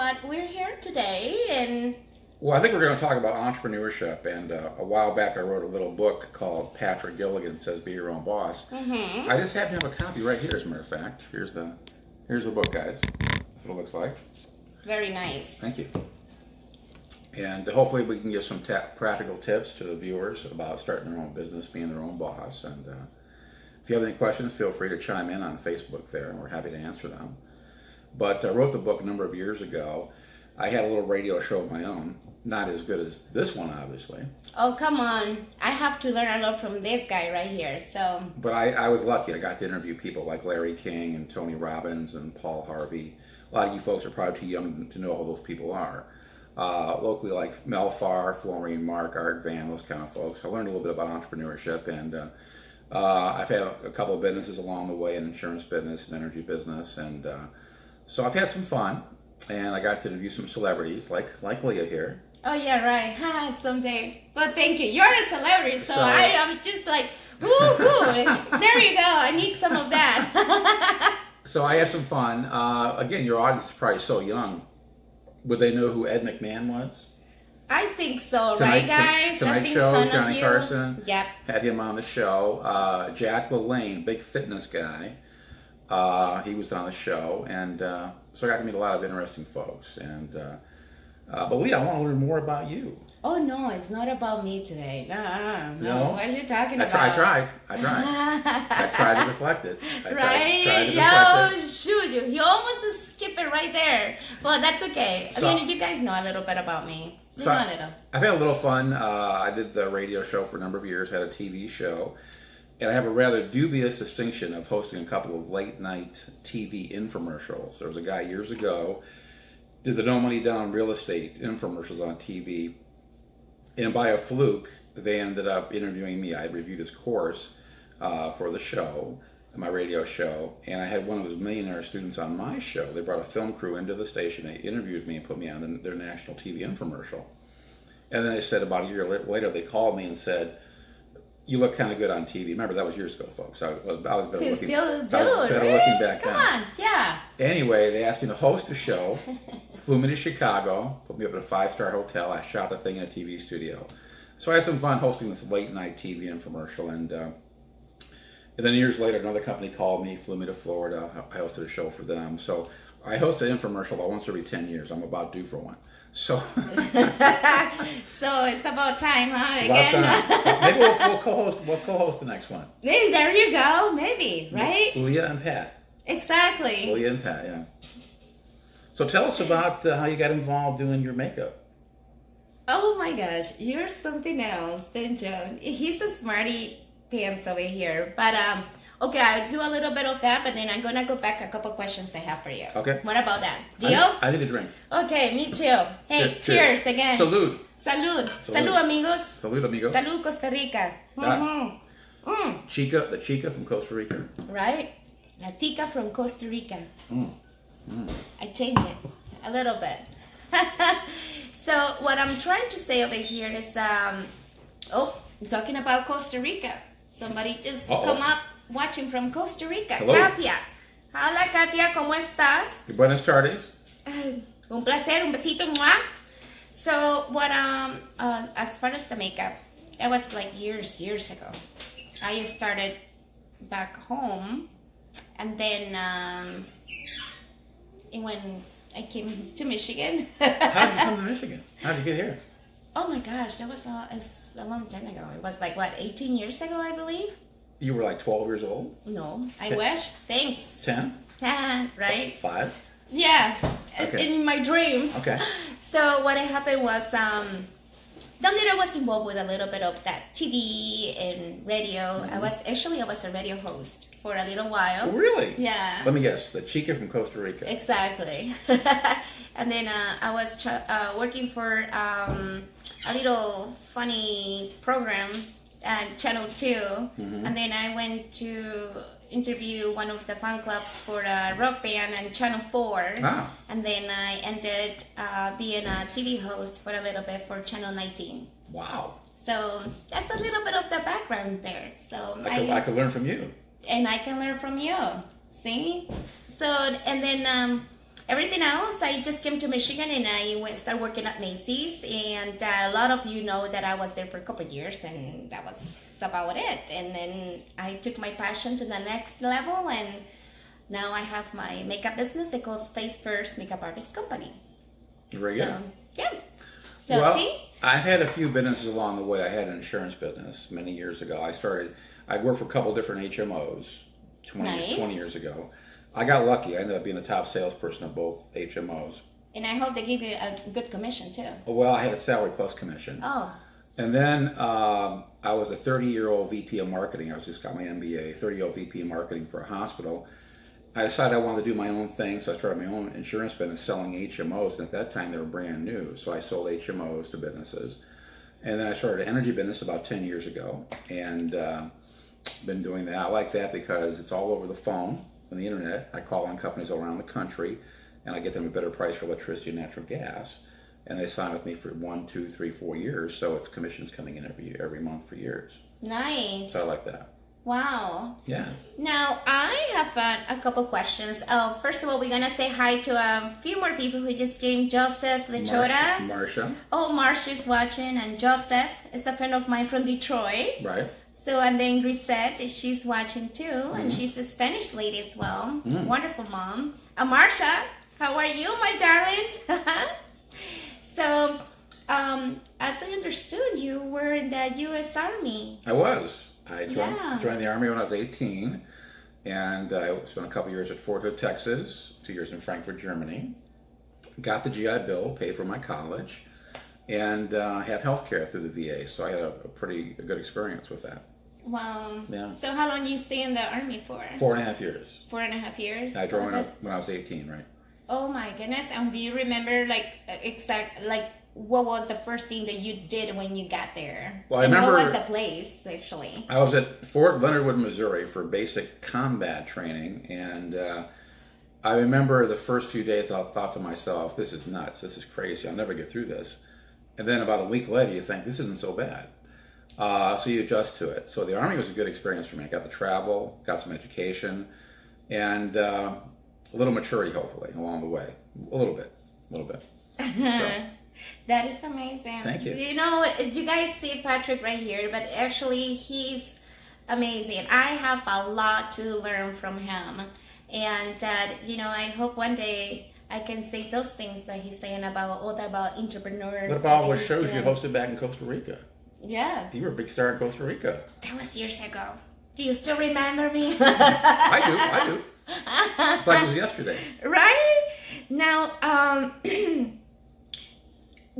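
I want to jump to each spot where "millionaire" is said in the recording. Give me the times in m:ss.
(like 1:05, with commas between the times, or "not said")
2:11.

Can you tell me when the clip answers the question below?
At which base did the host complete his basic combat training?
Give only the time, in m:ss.
7:07.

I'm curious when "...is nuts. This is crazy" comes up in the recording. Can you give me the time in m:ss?
7:14.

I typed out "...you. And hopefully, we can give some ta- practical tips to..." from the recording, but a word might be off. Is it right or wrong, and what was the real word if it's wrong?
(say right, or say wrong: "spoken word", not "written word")
right.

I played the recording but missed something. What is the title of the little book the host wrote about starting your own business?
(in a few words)
Patrick Gilligan Says Be Your Own Boss.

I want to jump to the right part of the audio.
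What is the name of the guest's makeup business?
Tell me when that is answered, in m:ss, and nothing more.
5:12.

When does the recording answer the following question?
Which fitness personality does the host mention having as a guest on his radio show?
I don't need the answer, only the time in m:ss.
1:23.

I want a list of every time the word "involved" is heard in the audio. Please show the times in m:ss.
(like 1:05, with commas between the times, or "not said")
3:00, 4:18.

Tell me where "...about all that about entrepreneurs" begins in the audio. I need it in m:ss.
7:45.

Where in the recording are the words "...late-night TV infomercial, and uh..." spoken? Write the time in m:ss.
2:35.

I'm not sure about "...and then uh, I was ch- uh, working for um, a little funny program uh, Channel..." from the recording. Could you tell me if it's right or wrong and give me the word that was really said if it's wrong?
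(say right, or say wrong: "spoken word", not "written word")
right.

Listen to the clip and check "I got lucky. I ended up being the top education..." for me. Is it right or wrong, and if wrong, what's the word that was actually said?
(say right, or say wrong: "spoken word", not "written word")
wrong: "salesperson", not "education".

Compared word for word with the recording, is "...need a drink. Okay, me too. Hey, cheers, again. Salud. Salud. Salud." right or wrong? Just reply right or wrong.
right.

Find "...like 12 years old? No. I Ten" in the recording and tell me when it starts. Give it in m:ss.
4:08.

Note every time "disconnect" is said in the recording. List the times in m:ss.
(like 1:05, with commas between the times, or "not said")
not said.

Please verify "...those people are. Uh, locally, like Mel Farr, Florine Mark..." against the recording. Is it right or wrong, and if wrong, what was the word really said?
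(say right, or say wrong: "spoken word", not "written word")
right.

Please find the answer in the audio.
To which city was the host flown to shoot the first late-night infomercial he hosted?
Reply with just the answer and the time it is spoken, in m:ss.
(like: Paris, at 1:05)
Chicago, at 2:30.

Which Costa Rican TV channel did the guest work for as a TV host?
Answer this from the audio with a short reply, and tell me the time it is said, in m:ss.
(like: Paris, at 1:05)
Channel 19, at 4:47.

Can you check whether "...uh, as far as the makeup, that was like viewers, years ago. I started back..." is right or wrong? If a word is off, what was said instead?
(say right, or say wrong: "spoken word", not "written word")
wrong: "years", not "viewers".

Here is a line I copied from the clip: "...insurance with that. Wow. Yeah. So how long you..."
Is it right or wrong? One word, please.
wrong.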